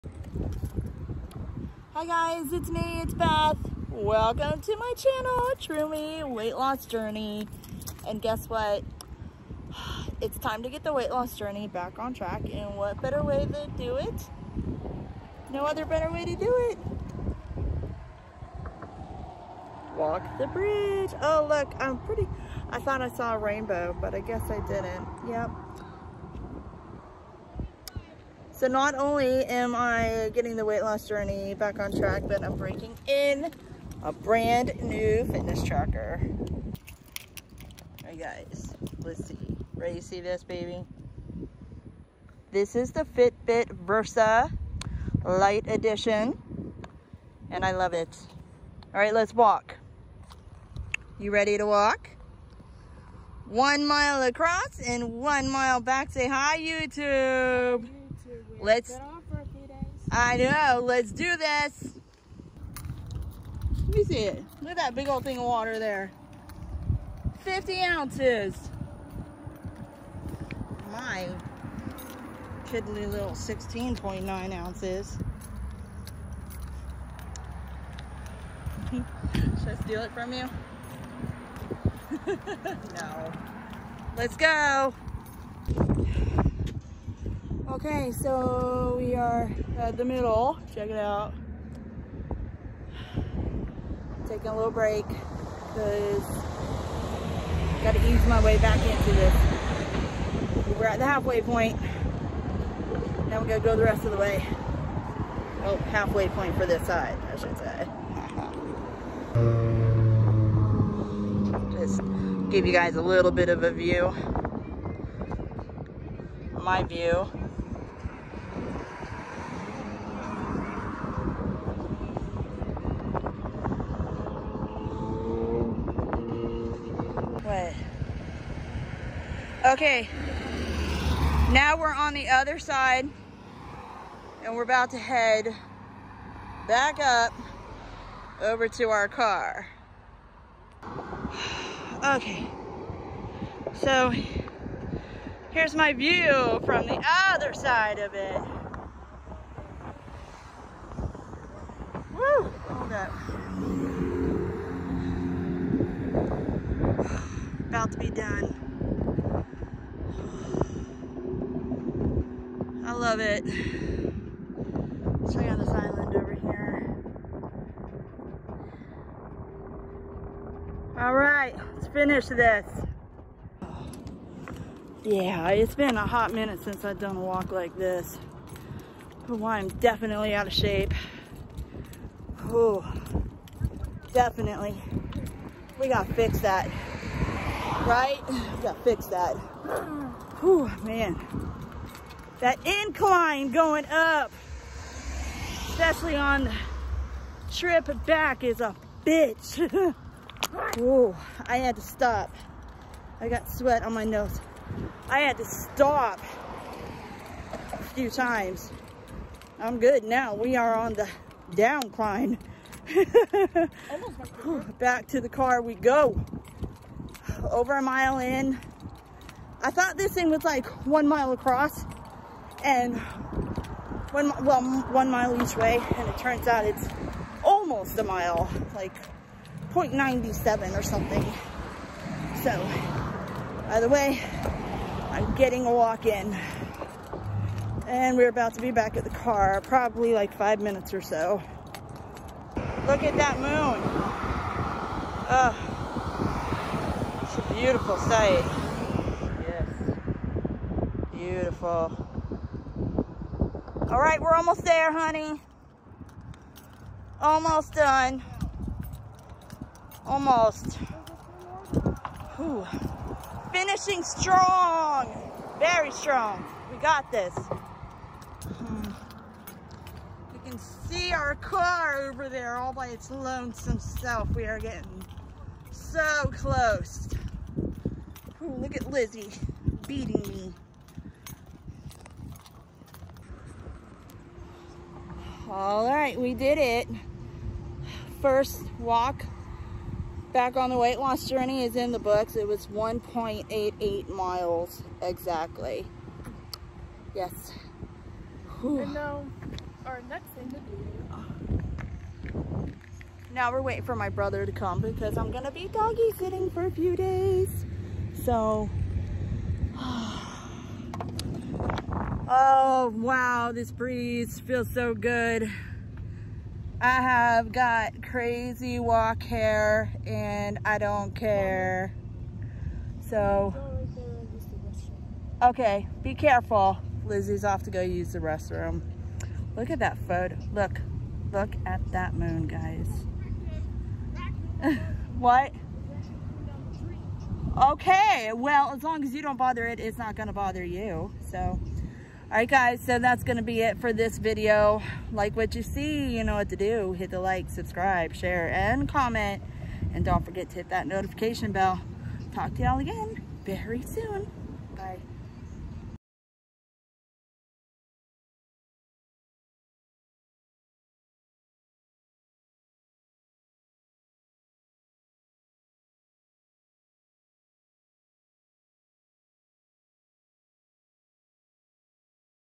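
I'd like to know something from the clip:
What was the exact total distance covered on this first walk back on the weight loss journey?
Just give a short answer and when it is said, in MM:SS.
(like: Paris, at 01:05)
1.88 miles, at 04:52.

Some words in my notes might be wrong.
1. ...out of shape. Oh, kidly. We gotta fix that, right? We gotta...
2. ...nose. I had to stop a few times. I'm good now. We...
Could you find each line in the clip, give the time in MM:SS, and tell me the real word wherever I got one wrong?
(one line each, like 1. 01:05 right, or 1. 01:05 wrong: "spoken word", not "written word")
1. 03:00 wrong: "definitely", not "kidly"
2. 03:24 right.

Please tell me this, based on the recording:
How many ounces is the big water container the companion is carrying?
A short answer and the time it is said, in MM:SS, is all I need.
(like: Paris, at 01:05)
50 ounces, at 01:07.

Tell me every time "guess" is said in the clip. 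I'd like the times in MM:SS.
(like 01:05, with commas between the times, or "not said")
00:08, 00:24.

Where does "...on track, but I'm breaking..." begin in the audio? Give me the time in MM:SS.
00:31.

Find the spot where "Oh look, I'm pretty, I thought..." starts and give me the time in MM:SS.
00:21.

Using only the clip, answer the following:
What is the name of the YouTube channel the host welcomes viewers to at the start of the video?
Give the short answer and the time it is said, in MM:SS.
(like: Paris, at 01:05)
Tru Me Weight Loss Journey, at 00:05.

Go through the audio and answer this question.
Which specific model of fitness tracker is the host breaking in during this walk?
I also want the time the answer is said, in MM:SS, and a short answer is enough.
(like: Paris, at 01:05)
Fitbit Versa Lite Edition, at 00:43.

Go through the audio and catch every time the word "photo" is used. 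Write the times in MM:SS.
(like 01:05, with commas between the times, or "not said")
05:30.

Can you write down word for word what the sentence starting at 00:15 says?
No other better way to do it.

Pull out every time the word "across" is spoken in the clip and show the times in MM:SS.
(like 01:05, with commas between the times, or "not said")
00:54, 03:41.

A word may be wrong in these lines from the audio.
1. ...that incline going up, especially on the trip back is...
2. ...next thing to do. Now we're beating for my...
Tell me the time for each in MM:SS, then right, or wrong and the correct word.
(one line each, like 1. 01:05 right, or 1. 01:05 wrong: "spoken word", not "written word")
1. 03:12 right
2. 05:00 wrong: "waiting", not "beating".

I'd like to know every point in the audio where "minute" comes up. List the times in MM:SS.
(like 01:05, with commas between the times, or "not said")
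02:56, 04:00.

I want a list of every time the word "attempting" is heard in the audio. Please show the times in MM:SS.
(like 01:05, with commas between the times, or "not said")
not said.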